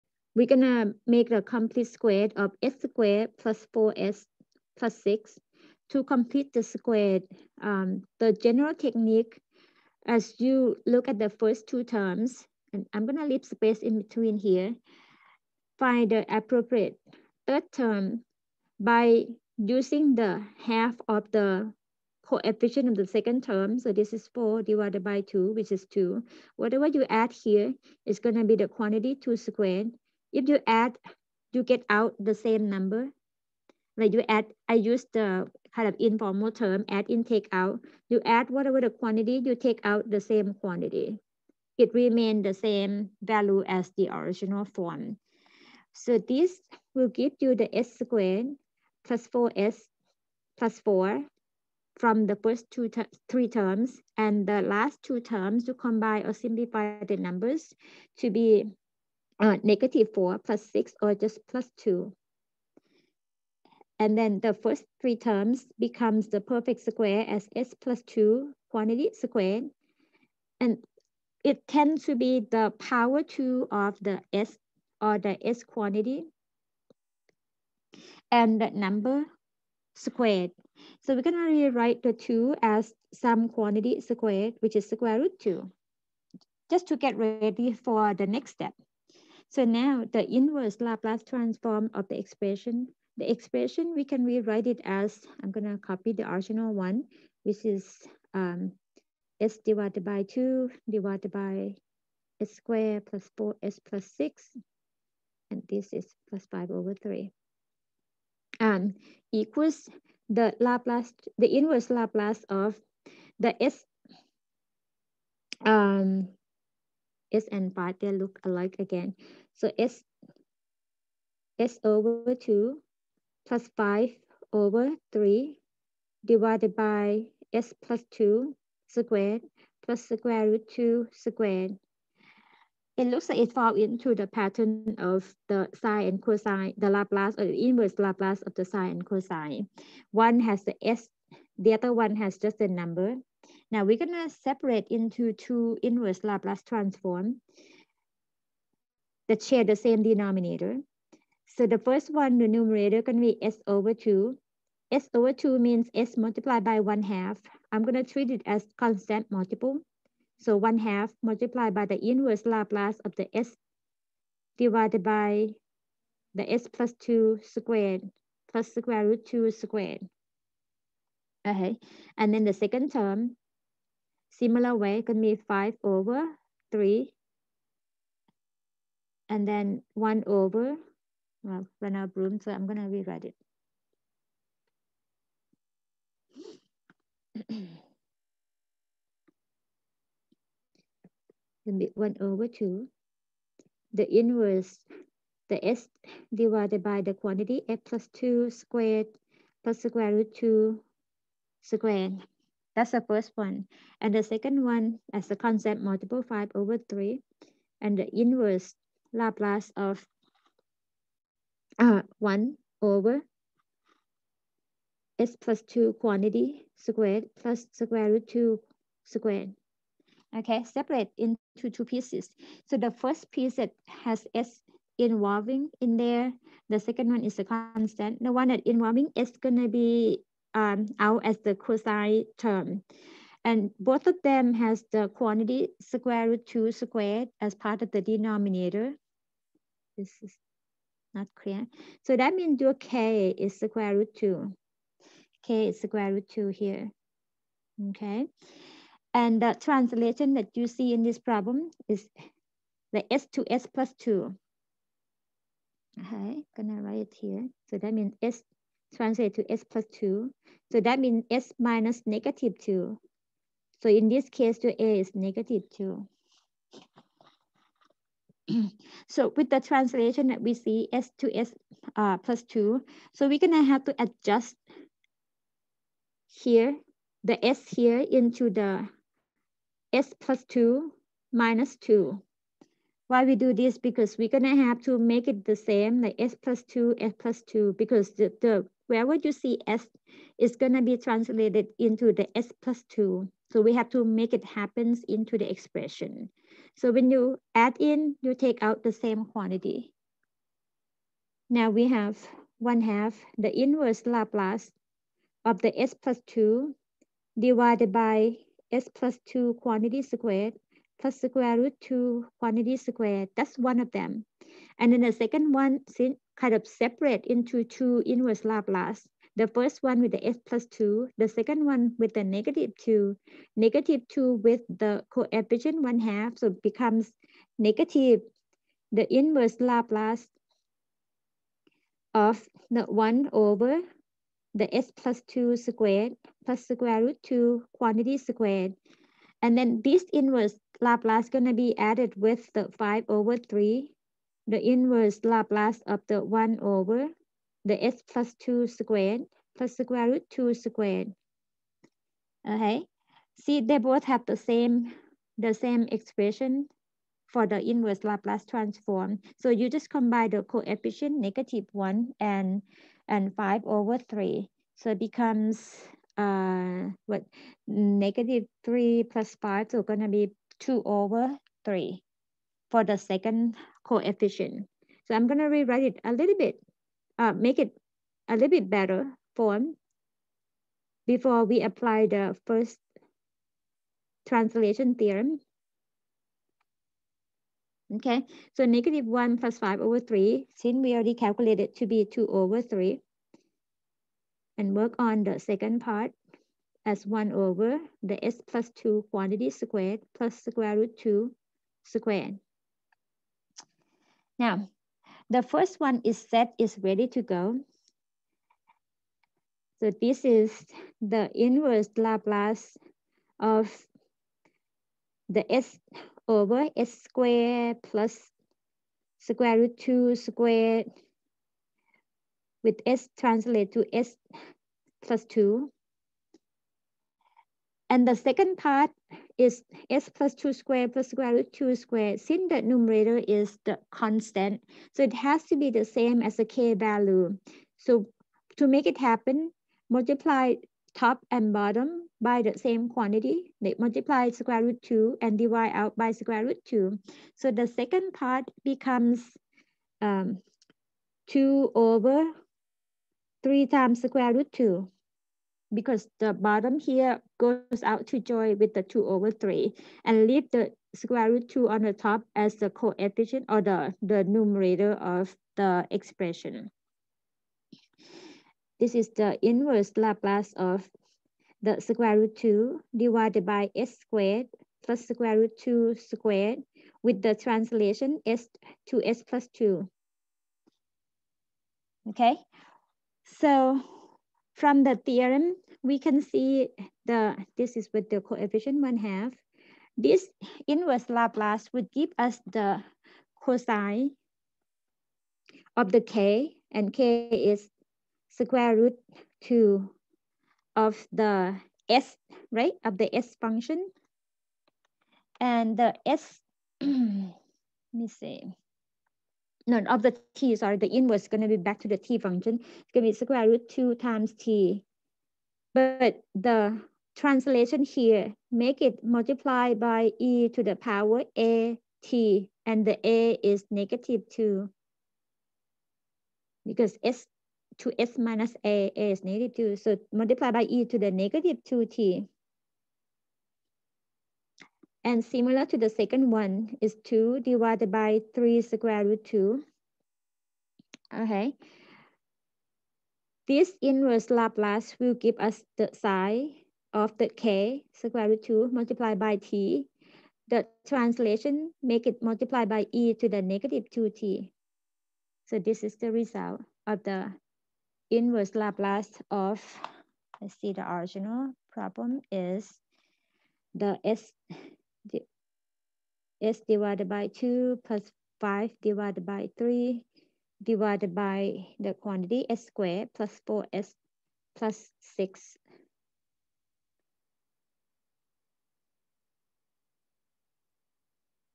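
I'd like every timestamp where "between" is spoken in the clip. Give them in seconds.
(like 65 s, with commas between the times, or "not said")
14 s.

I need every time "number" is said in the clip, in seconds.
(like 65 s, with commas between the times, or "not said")
32 s, 57 s, 78 s, 142 s.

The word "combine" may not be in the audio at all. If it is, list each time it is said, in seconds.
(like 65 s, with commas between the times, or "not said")
55 s, 359 s.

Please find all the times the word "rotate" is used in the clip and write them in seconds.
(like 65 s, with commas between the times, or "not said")
not said.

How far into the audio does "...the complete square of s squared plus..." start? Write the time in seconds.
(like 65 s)
1 s.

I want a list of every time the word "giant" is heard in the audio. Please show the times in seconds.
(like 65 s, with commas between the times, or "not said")
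not said.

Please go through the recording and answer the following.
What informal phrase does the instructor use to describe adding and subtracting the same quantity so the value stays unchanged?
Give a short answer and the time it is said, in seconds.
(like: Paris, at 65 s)
add in, take out, at 36 s.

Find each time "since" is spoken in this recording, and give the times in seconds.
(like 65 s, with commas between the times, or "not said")
315 s, 390 s, 432 s.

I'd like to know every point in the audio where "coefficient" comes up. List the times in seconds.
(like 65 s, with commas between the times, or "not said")
22 s, 325 s, 360 s, 373 s, 462 s, 488 s.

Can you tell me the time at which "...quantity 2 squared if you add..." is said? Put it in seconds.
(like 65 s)
28 s.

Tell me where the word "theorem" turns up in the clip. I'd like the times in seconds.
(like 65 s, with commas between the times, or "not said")
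384 s, 484 s.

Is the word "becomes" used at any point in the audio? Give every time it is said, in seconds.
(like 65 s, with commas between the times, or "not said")
65 s, 326 s, 364 s, 448 s.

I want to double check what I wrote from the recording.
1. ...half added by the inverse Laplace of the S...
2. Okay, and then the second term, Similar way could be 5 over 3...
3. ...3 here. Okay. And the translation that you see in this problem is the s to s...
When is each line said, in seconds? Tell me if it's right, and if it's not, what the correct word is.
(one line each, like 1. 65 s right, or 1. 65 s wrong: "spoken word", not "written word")
1. 160 s wrong: "multiplied", not "added"
2. 171 s right
3. 246 s wrong: "2", not "3".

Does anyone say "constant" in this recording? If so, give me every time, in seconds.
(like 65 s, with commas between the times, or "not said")
158 s, 205 s, 227 s, 433 s.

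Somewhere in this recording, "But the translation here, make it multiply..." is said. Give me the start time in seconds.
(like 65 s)
515 s.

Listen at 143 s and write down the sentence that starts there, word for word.
Now we're gonna separate into two inverse Laplace transform that share the same denominator.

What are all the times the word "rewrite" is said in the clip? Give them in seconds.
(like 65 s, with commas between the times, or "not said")
81 s, 94 s, 182 s, 375 s.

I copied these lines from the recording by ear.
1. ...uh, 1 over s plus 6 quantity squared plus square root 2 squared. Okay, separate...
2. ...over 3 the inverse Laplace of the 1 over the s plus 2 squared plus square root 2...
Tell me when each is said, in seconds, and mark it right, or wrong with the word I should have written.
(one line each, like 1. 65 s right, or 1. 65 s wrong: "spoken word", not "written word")
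1. 211 s wrong: "2", not "6"
2. 343 s right.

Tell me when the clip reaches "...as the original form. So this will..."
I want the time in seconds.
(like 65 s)
43 s.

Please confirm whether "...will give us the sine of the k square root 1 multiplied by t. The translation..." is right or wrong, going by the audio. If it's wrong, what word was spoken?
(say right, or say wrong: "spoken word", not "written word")
wrong: "2", not "1".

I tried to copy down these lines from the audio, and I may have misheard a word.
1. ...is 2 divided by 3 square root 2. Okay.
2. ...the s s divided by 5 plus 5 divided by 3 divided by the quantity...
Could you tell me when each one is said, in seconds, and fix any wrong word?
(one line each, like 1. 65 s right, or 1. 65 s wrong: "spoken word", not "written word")
1. 536 s right
2. 563 s wrong: "2", not "5".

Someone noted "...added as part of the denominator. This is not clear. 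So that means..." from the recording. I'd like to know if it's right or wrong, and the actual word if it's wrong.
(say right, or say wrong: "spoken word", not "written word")
wrong: "squared", not "added".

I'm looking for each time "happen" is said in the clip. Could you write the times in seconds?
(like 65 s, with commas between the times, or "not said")
294 s, 438 s.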